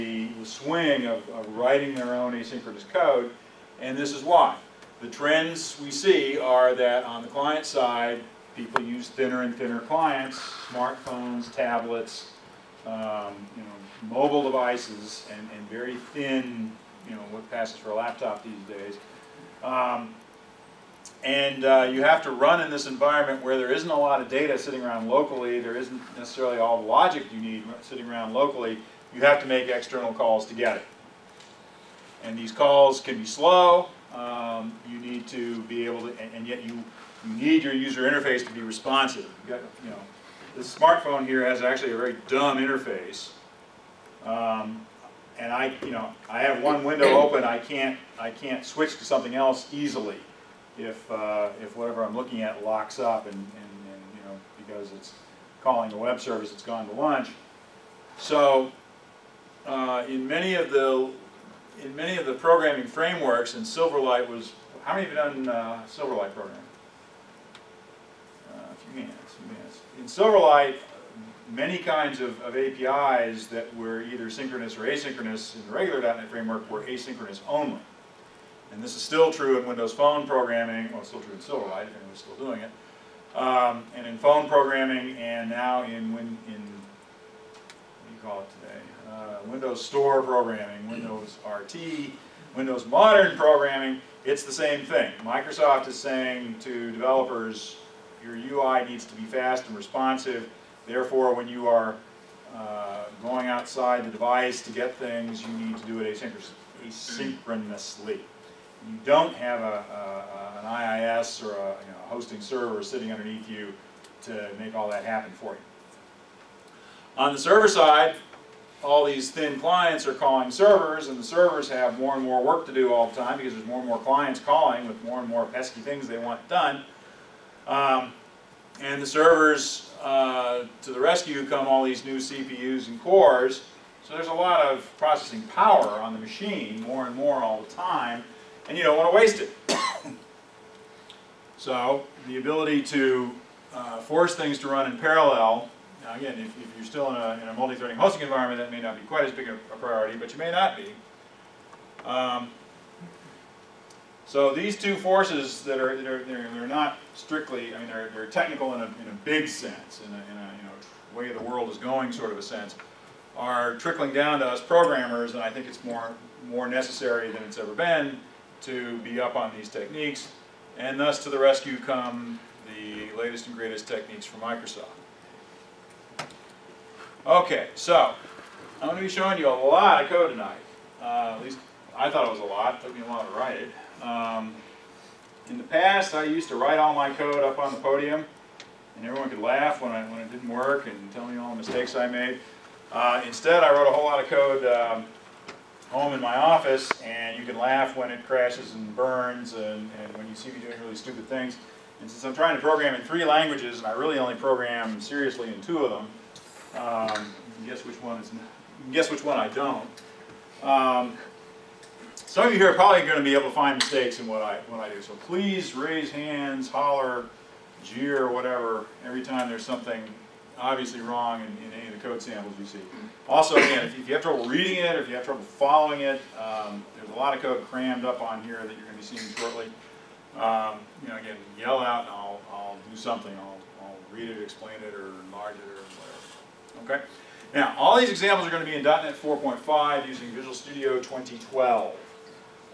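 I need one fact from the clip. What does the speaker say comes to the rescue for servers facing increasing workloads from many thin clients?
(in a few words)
new CPUs and cores.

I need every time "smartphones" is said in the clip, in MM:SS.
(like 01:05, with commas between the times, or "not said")
00:10, 00:40.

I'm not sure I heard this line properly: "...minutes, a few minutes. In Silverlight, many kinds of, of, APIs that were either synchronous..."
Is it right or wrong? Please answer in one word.
right.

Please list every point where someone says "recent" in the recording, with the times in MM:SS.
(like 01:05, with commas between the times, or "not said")
not said.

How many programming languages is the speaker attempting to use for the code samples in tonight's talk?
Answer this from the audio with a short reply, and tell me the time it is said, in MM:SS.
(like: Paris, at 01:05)
3, at 03:23.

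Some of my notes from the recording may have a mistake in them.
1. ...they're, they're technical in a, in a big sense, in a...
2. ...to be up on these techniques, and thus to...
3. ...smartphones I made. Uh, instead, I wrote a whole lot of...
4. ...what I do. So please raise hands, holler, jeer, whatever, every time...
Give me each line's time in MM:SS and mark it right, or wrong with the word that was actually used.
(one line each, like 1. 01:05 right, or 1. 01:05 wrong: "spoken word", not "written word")
1. 02:37 right
2. 02:48 right
3. 03:11 wrong: "mistakes", not "smartphones"
4. 03:34 right.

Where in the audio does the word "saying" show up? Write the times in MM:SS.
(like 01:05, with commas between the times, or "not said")
01:35.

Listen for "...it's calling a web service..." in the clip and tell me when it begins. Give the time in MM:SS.
00:54.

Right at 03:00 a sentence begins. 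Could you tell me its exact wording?
Uh, at least I thought it was a lot.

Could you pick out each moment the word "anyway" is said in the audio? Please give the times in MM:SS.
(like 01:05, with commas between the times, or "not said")
not said.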